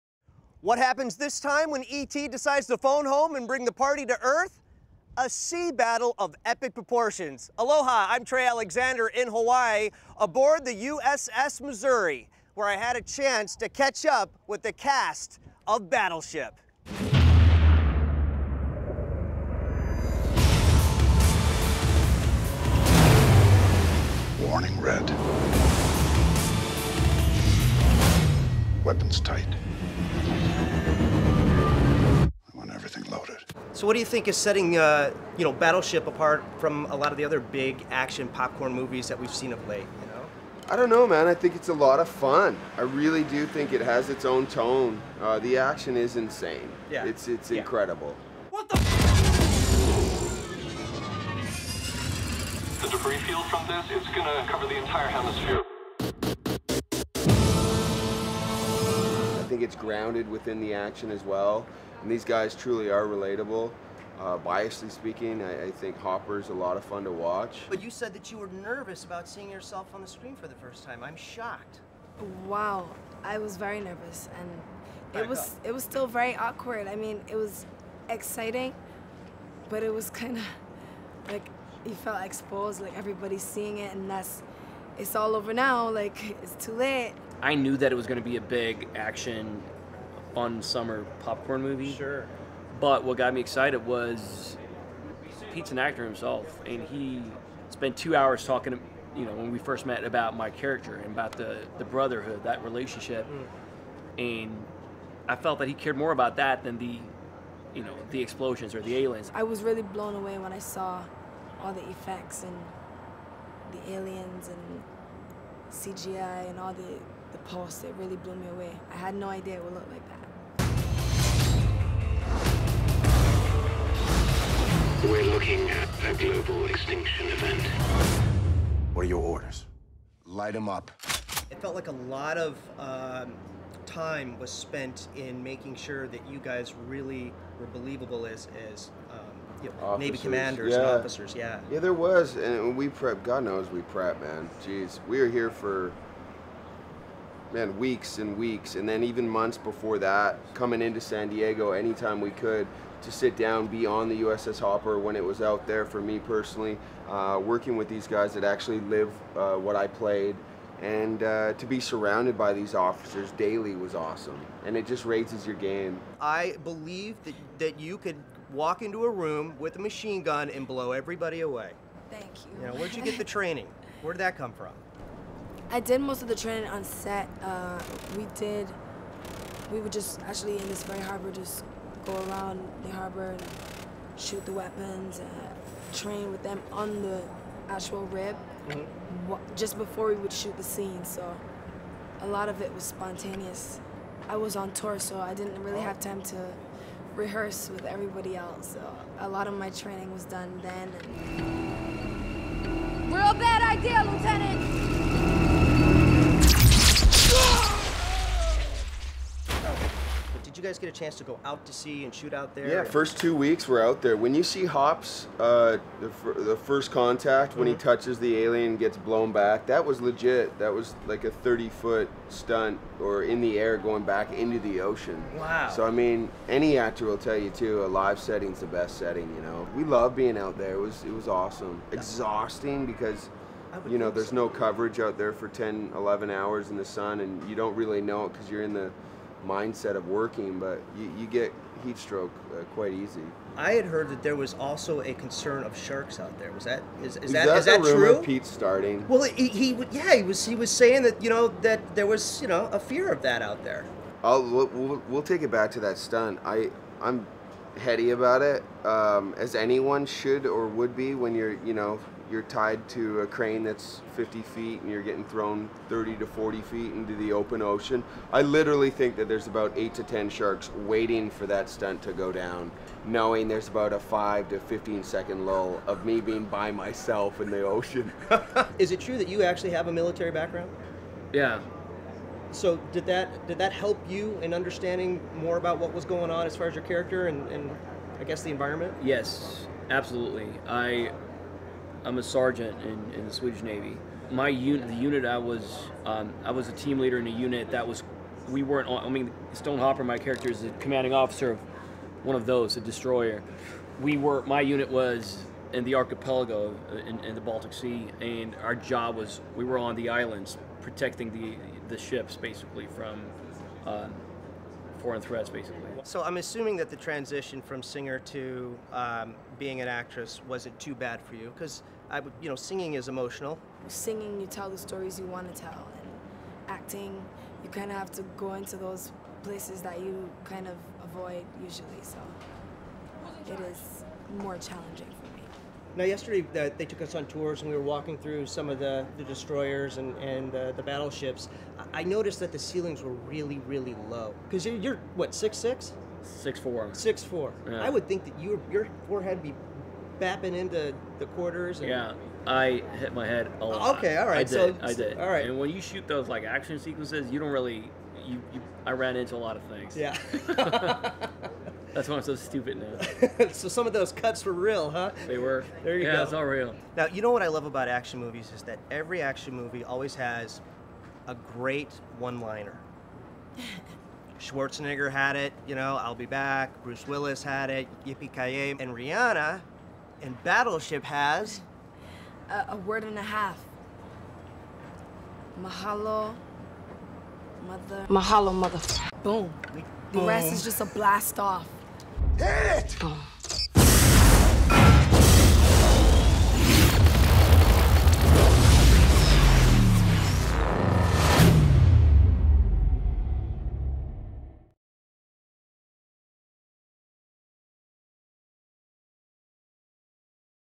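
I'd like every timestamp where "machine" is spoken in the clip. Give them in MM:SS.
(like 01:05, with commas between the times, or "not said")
02:49.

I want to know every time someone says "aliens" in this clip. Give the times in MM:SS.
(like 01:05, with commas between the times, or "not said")
01:48, 01:53, 03:38.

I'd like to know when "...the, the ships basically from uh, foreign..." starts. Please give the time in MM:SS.
05:11.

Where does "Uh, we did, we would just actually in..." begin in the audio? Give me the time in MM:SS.
02:57.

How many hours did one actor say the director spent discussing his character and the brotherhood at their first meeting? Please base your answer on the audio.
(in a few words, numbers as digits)
2.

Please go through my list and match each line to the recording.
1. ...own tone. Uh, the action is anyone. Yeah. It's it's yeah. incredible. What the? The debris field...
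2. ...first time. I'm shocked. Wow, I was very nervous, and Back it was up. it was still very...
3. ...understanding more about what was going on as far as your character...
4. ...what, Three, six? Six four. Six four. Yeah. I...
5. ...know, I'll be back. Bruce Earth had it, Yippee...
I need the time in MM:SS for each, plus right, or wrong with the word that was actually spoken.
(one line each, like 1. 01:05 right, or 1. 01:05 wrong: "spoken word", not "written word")
1. 00:44 wrong: "insane", not "anyone"
2. 01:10 right
3. 04:44 right
4. 05:45 wrong: "Six", not "Three"
5. 06:15 wrong: "Willis", not "Earth".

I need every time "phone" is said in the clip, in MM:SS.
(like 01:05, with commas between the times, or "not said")
00:02.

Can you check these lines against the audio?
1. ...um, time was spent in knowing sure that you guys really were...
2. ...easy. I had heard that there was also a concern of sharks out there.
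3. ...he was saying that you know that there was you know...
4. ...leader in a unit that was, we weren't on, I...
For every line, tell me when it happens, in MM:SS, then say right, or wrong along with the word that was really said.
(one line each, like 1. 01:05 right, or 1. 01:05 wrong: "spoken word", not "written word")
1. 02:12 wrong: "making", not "knowing"
2. 04:02 right
3. 04:10 right
4. 04:56 right.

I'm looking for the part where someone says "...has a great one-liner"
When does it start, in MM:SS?
06:10.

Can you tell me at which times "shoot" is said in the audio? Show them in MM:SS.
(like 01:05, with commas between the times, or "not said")
03:04, 03:10, 03:32, 05:55.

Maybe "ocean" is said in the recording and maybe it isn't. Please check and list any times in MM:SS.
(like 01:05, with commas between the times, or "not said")
03:44, 04:27, 04:37.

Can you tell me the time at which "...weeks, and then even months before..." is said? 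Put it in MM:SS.
02:28.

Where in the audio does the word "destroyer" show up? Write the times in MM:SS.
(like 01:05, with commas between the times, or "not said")
05:02, 05:39.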